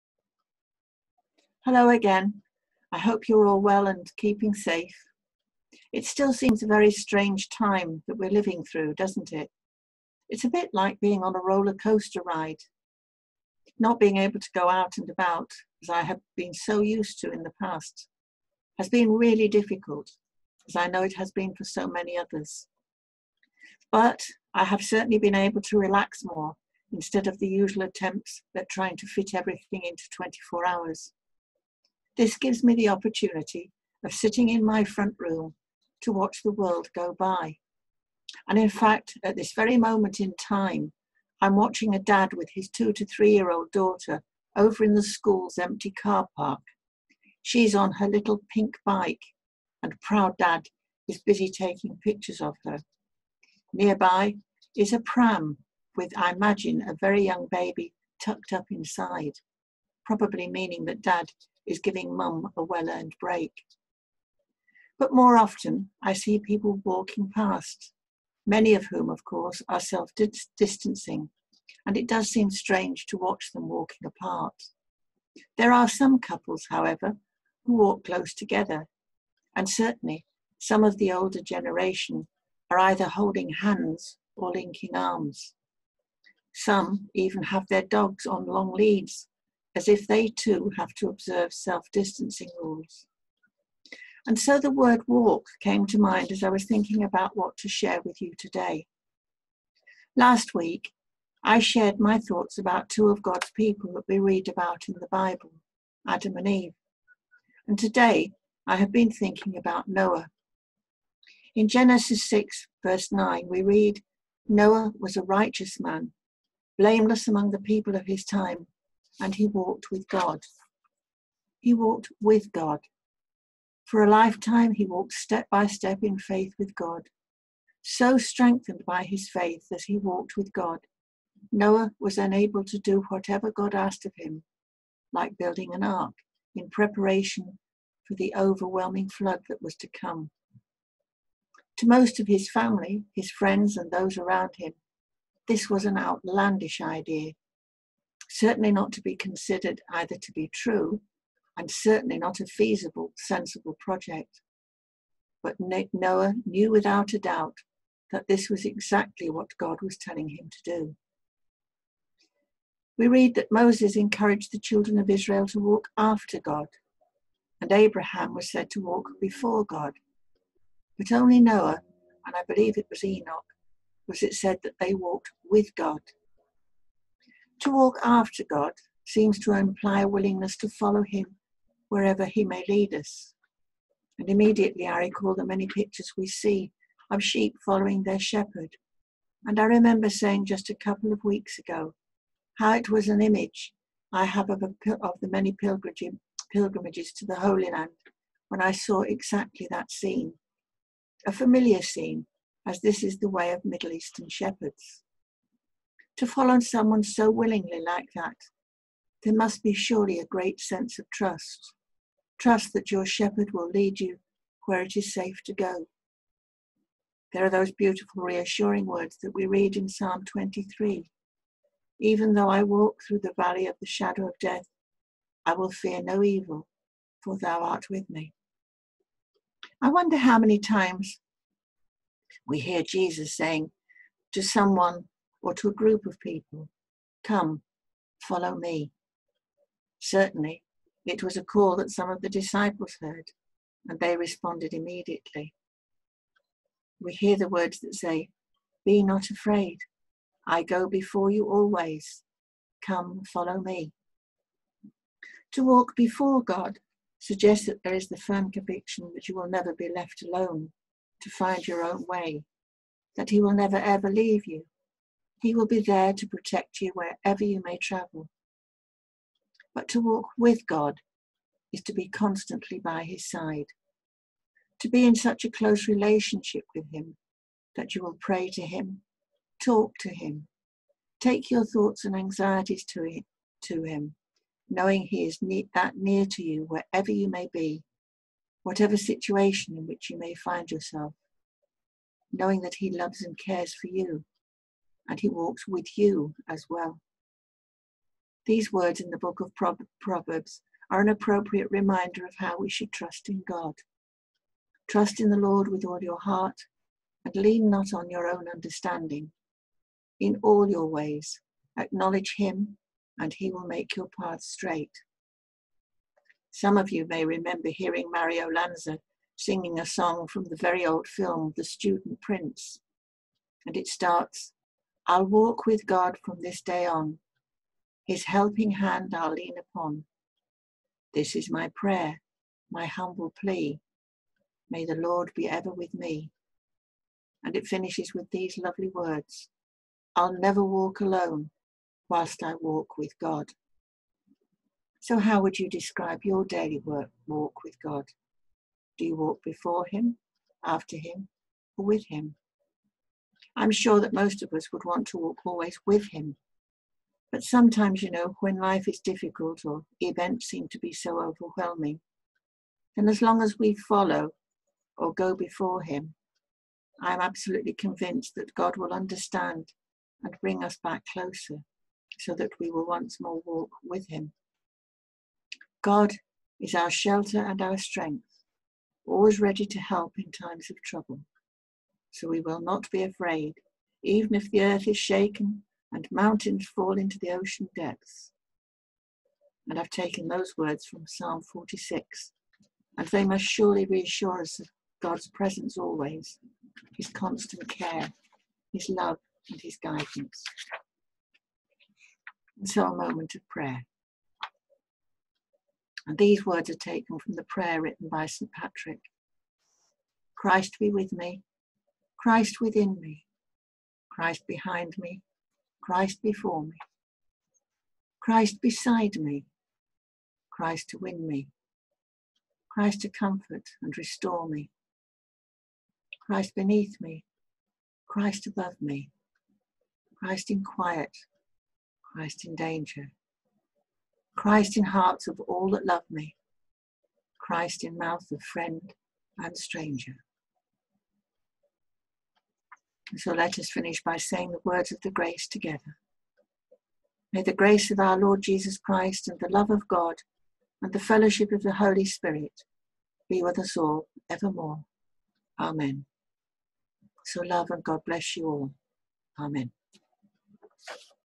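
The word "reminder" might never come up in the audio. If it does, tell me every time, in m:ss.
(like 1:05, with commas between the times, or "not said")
5:01.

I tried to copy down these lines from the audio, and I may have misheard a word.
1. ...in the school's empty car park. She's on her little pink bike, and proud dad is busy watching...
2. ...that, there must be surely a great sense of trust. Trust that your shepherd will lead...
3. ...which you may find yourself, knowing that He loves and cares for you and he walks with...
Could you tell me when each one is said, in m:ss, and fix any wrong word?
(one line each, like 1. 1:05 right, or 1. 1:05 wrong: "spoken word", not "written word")
1. 0:44 wrong: "taking", not "watching"
2. 3:28 right
3. 4:49 right.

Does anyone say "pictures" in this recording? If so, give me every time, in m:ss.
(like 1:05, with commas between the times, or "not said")
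0:52, 3:05.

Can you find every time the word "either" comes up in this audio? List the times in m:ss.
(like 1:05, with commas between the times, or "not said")
1:22, 2:29.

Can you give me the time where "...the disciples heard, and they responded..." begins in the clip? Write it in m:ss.
4:02.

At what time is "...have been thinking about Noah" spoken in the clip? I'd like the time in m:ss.
1:48.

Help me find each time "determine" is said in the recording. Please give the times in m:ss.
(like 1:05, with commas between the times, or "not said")
not said.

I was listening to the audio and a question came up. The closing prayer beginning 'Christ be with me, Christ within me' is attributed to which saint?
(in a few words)
St. Patrick.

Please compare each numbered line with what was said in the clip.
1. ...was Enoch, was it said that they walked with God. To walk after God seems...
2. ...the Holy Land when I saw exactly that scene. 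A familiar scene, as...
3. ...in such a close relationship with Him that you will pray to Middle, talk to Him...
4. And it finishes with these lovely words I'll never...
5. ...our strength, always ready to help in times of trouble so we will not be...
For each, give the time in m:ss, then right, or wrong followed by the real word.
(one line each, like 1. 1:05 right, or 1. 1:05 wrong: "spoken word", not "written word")
1. 2:52 right
2. 3:17 right
3. 4:35 wrong: "Him", not "Middle"
4. 5:37 right
5. 6:17 right.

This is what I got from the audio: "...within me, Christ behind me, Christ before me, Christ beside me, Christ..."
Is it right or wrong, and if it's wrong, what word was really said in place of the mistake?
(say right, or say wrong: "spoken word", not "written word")
right.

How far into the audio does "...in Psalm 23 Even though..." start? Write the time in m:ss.
3:39.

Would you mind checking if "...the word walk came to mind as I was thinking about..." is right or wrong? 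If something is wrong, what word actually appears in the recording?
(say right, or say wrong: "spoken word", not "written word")
right.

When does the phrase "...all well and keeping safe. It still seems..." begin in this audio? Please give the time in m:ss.
0:03.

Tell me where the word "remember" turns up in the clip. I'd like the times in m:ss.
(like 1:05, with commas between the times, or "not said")
3:09, 5:17.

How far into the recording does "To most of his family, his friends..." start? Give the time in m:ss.
2:21.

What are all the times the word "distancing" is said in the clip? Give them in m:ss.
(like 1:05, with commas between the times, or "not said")
1:10, 1:31.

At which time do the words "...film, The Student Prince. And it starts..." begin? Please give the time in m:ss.
5:21.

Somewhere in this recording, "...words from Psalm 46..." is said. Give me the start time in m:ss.
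6:30.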